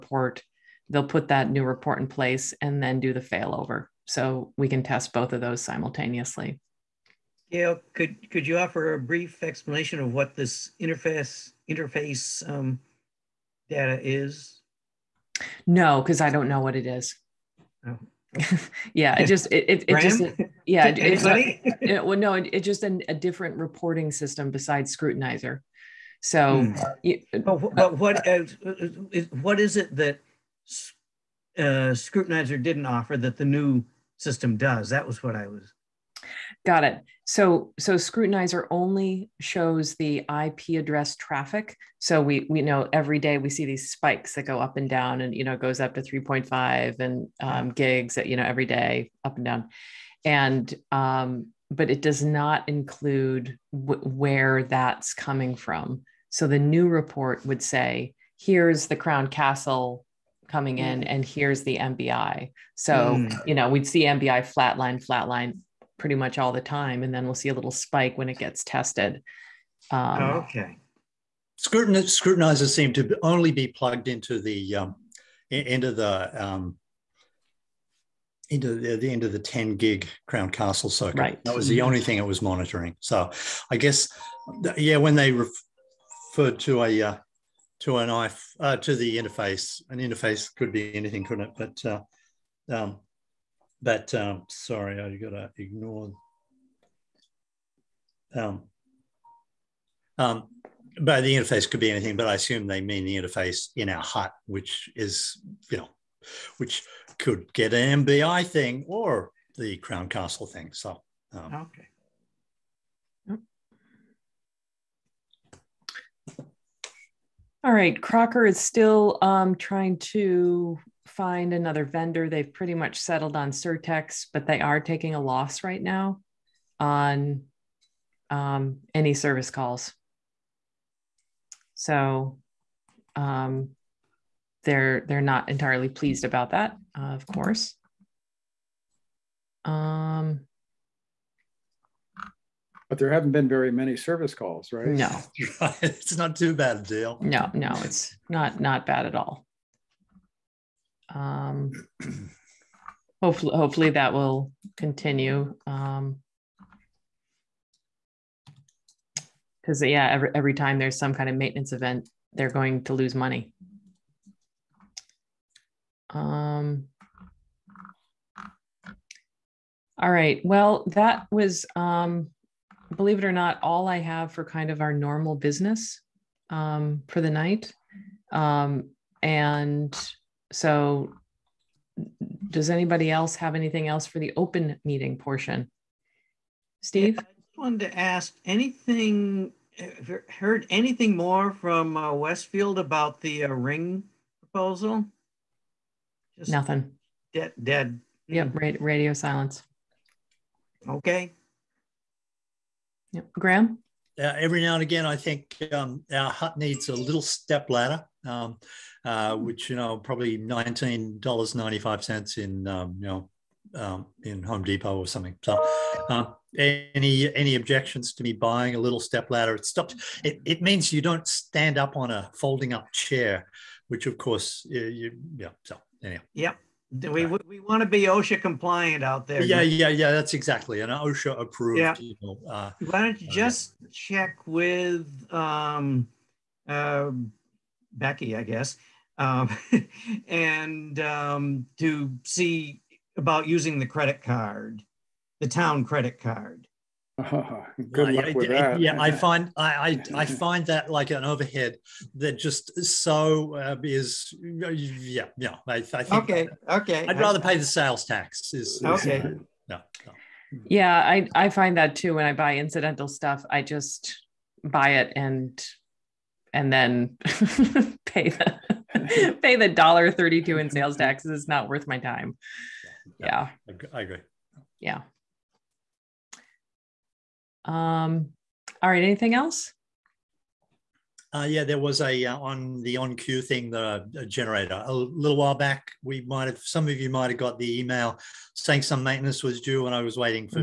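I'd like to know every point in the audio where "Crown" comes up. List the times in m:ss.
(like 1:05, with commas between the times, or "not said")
0:58, 1:20, 1:49.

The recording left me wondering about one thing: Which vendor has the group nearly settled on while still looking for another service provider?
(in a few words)
Certex.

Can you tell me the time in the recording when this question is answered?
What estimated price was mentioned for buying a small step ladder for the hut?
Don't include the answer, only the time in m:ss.
3:30.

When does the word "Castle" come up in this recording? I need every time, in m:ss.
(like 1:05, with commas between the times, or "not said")
0:59, 1:20, 1:50.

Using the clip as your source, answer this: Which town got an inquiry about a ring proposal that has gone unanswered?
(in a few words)
Westfield.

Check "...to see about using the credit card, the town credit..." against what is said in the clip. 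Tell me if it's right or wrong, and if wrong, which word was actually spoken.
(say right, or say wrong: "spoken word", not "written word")
right.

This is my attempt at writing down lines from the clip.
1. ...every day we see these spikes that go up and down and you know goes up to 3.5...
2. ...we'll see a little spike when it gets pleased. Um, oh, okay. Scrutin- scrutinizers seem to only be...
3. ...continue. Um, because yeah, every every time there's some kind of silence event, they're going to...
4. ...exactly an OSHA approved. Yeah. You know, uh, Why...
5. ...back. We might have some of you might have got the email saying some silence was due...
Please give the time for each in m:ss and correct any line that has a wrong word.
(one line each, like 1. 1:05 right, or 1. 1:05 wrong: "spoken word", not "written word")
1. 0:42 right
2. 1:07 wrong: "tested", not "pleased"
3. 2:34 wrong: "maintenance", not "silence"
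4. 3:50 right
5. 4:45 wrong: "maintenance", not "silence".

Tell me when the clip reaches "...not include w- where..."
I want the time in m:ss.
0:52.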